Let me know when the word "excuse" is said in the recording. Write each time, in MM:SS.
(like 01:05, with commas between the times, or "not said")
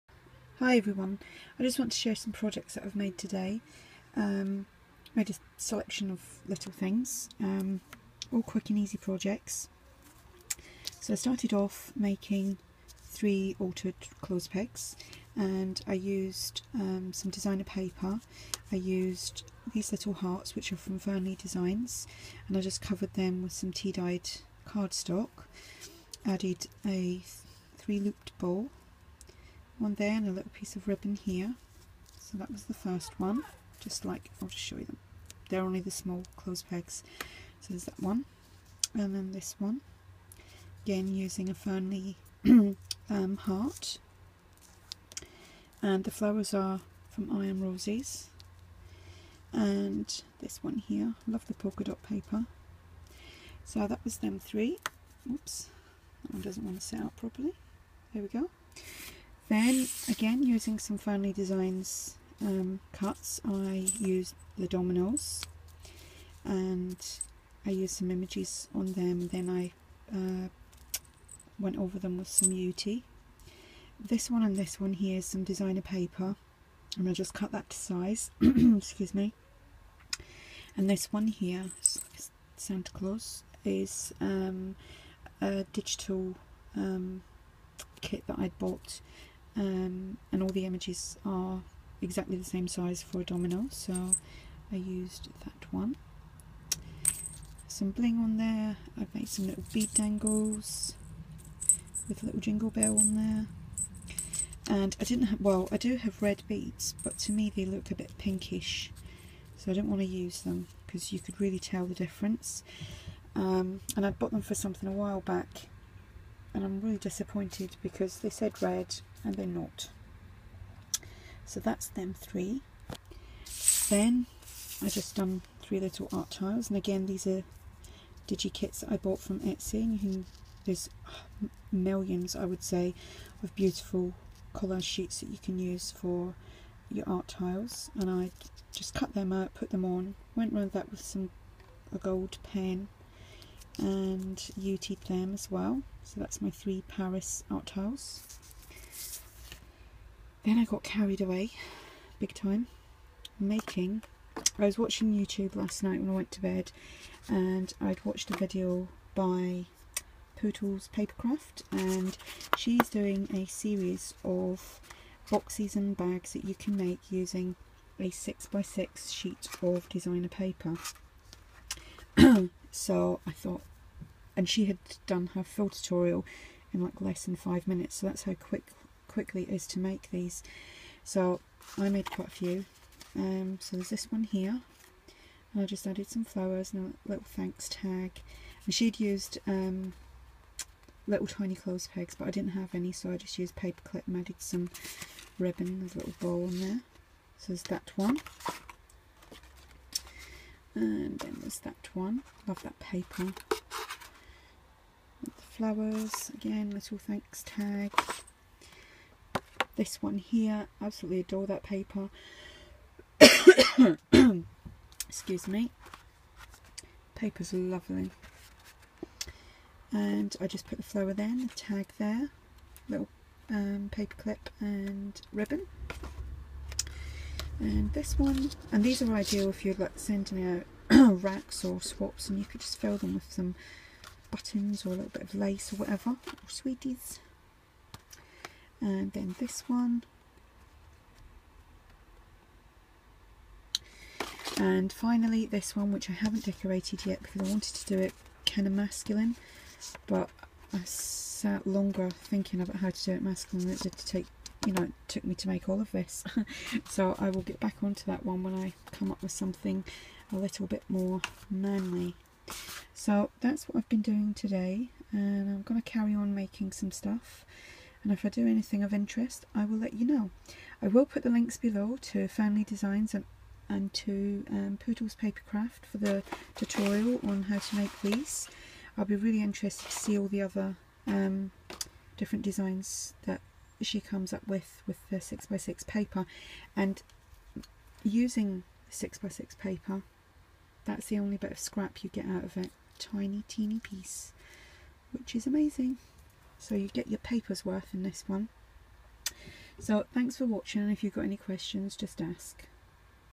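01:18, 03:35.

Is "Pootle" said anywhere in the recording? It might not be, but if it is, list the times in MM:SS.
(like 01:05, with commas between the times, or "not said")
02:40, 04:34.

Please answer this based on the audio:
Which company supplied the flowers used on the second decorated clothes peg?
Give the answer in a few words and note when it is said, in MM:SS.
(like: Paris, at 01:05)
Iron Roses, at 00:47.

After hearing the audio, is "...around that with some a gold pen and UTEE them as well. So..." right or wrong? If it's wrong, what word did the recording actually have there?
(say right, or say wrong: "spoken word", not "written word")
right.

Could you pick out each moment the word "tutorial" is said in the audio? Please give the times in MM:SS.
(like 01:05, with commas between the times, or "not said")
02:55, 04:36.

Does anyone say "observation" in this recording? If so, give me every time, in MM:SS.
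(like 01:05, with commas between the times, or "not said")
not said.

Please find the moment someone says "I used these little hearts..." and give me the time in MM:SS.
00:18.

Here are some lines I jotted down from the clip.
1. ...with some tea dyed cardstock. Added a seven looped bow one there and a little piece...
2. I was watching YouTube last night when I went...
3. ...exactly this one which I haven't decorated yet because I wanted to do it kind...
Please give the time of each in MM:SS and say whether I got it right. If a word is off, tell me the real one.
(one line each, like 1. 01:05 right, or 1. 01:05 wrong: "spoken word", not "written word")
1. 00:23 wrong: "three", not "seven"
2. 02:34 right
3. 04:04 wrong: "finally", not "exactly".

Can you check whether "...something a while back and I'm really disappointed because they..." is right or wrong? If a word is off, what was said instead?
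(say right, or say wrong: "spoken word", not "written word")
right.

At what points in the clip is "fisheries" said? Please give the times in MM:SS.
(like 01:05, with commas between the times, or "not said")
not said.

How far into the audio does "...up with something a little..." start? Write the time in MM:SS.
04:19.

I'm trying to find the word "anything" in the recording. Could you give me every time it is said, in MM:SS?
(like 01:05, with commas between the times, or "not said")
04:28.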